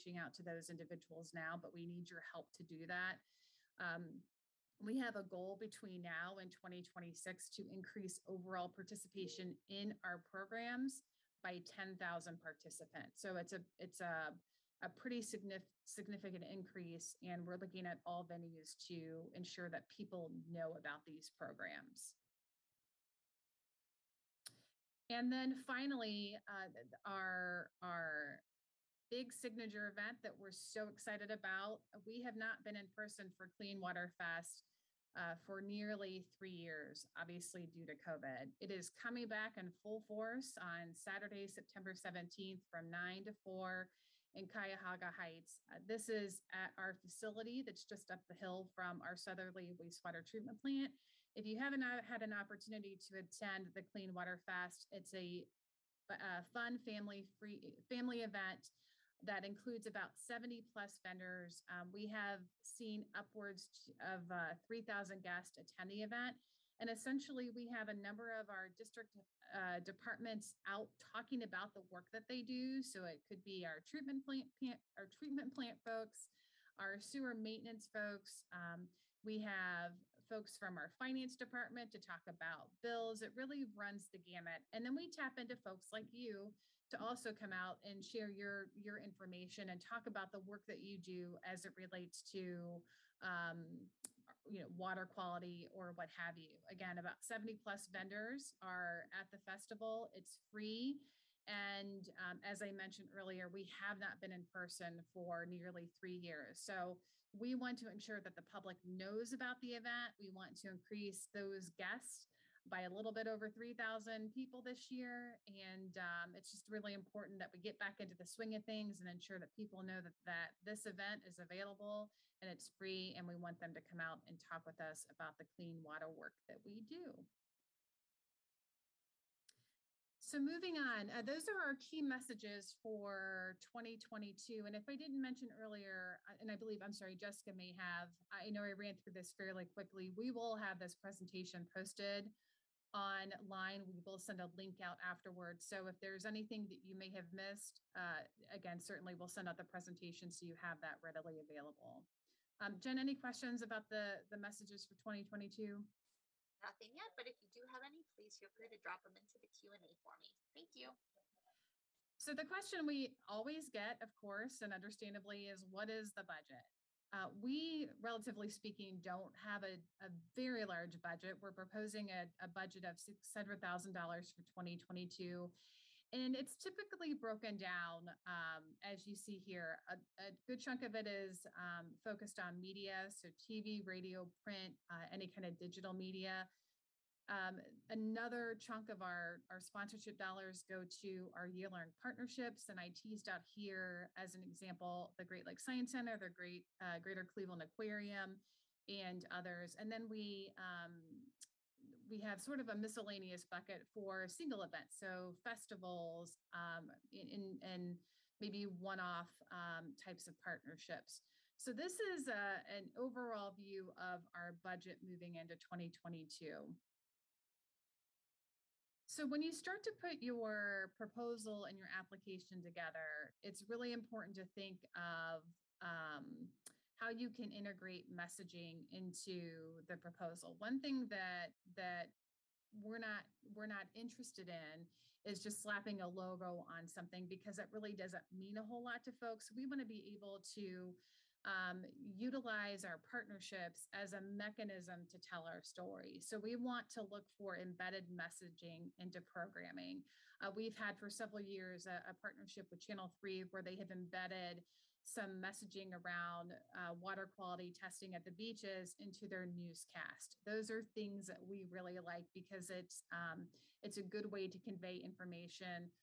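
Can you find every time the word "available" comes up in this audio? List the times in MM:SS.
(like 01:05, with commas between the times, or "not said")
02:01, 02:31.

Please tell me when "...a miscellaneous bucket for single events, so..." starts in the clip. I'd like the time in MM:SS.
03:22.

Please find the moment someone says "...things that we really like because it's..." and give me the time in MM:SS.
04:20.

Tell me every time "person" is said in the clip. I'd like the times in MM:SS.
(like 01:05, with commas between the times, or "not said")
00:32, 01:44.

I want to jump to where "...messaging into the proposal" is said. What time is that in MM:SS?
03:48.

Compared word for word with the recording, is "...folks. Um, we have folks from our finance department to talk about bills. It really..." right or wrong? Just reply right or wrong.
right.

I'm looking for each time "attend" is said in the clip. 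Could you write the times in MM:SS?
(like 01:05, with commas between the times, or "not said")
00:53, 01:05.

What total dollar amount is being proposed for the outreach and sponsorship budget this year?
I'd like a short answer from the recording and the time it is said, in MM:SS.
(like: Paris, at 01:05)
$600,000, at 02:52.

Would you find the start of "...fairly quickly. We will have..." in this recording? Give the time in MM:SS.
02:19.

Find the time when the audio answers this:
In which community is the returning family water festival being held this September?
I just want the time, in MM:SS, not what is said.
00:44.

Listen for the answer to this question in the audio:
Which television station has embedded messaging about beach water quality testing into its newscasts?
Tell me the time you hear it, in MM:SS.
04:12.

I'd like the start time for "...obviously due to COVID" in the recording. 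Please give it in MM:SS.
00:37.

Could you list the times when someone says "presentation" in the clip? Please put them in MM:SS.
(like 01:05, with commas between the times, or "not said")
02:20, 02:29.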